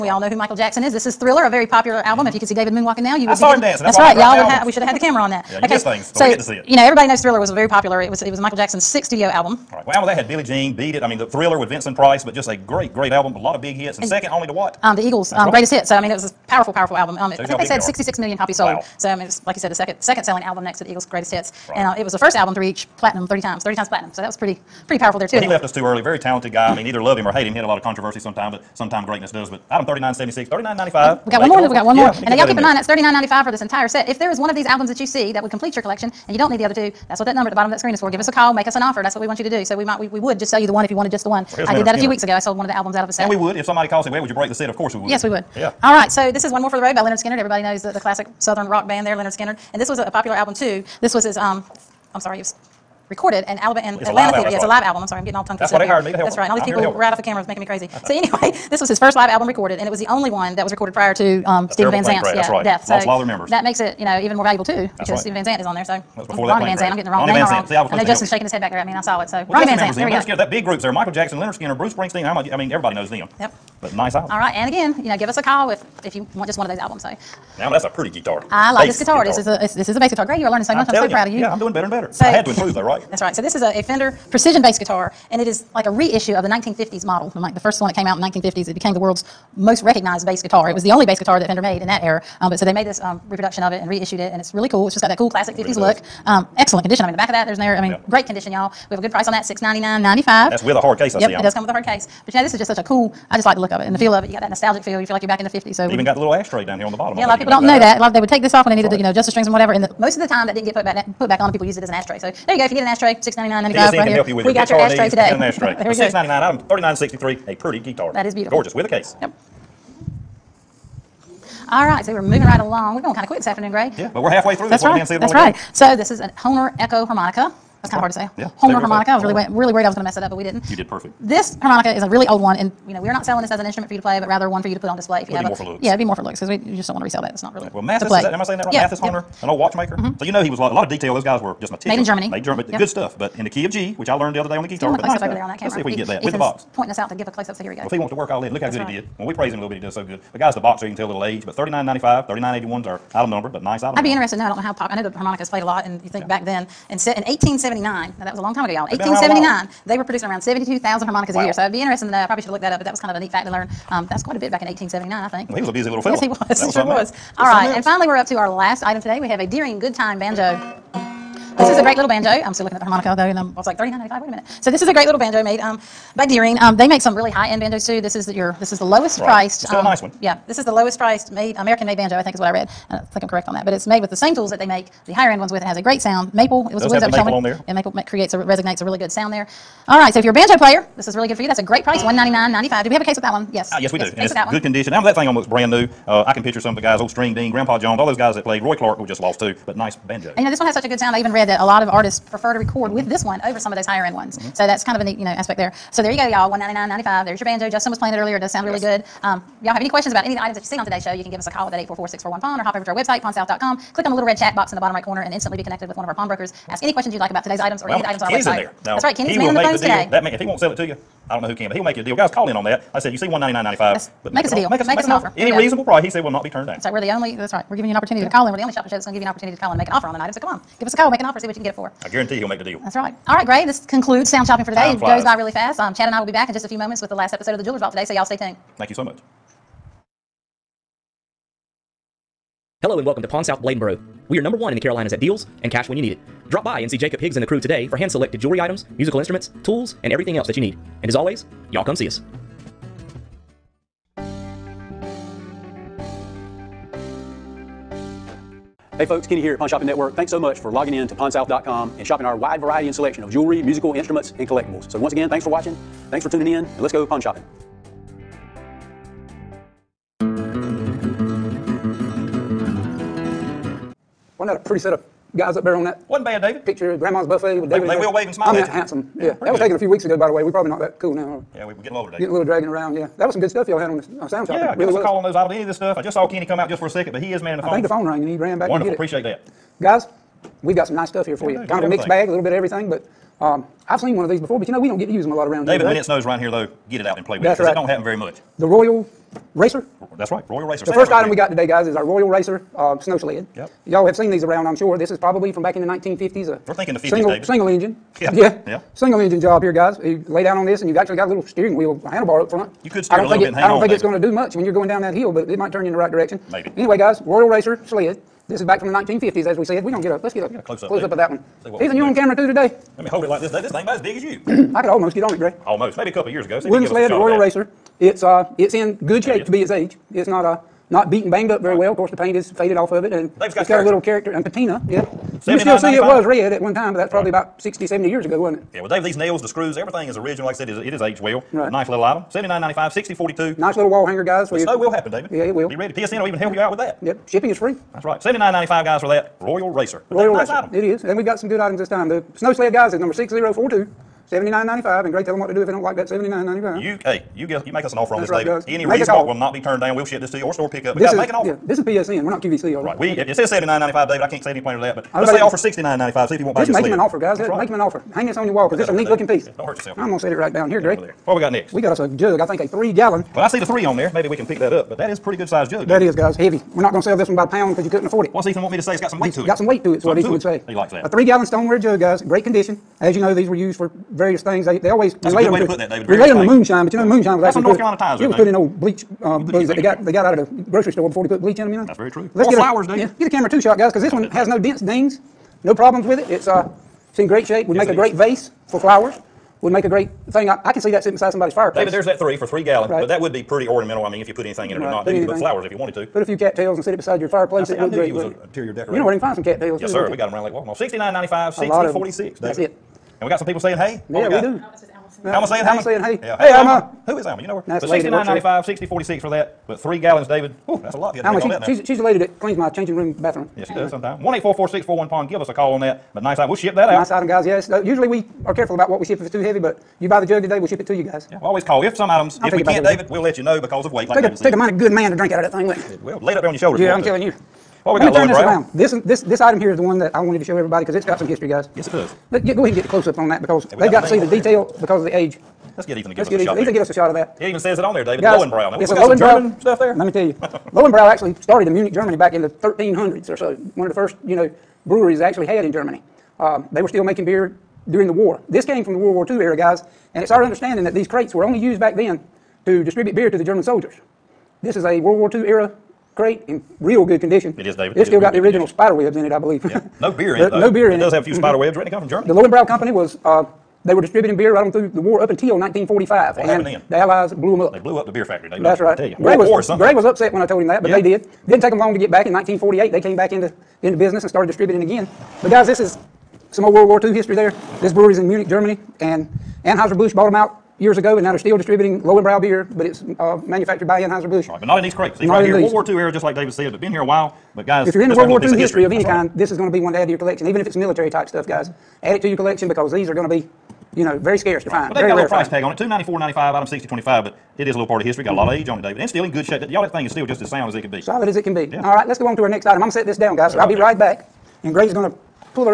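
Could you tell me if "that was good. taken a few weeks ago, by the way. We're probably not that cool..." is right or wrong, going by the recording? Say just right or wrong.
right.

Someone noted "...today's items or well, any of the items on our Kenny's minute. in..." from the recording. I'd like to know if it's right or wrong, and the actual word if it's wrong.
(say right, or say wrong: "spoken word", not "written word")
wrong: "website", not "minute".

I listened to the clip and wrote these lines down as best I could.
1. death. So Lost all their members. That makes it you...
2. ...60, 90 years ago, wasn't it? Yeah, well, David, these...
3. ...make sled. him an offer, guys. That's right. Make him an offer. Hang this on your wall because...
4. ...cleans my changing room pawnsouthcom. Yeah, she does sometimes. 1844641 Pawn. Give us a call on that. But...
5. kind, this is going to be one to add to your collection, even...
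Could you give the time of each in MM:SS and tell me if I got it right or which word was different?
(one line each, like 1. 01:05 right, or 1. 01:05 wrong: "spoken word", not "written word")
1. 01:02 right
2. 05:37 wrong: "70", not "90"
3. 06:06 right
4. 07:02 wrong: "bathroom", not "pawnsouthcom"
5. 08:19 right.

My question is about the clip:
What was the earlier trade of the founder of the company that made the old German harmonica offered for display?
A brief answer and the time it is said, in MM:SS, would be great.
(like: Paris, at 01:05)
watchmaker, at 02:19.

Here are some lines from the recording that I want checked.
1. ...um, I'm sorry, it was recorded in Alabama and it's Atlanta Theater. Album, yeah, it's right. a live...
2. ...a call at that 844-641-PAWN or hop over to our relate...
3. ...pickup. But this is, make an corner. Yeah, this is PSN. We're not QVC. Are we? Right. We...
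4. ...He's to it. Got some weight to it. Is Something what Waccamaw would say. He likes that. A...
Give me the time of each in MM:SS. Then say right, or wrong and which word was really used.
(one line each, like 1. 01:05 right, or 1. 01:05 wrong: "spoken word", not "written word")
1. 00:51 right
2. 03:31 wrong: "website", not "relate"
3. 06:00 wrong: "offer", not "corner"
4. 06:19 wrong: "Ethan", not "Waccamaw".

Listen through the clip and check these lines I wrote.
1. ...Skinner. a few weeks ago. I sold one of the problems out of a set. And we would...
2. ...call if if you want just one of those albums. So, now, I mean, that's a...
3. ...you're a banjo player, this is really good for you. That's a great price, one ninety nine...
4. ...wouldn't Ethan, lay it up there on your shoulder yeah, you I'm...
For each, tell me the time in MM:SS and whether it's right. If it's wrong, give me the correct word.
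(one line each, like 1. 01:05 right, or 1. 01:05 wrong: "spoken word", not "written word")
1. 00:41 wrong: "albums", not "problems"
2. 01:15 right
3. 03:10 right
4. 07:15 wrong: "Well", not "Ethan".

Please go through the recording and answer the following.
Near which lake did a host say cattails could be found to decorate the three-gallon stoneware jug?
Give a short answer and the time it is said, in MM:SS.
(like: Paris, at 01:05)
Lake Waccamaw, at 06:50.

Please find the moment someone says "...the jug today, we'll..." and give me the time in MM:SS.
07:10.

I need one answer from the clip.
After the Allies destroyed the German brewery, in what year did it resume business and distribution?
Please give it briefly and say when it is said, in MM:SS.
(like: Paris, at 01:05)
1948, at 08:02.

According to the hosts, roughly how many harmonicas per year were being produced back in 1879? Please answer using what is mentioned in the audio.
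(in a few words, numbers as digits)
72,000.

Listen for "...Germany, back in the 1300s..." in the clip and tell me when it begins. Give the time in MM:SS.
07:31.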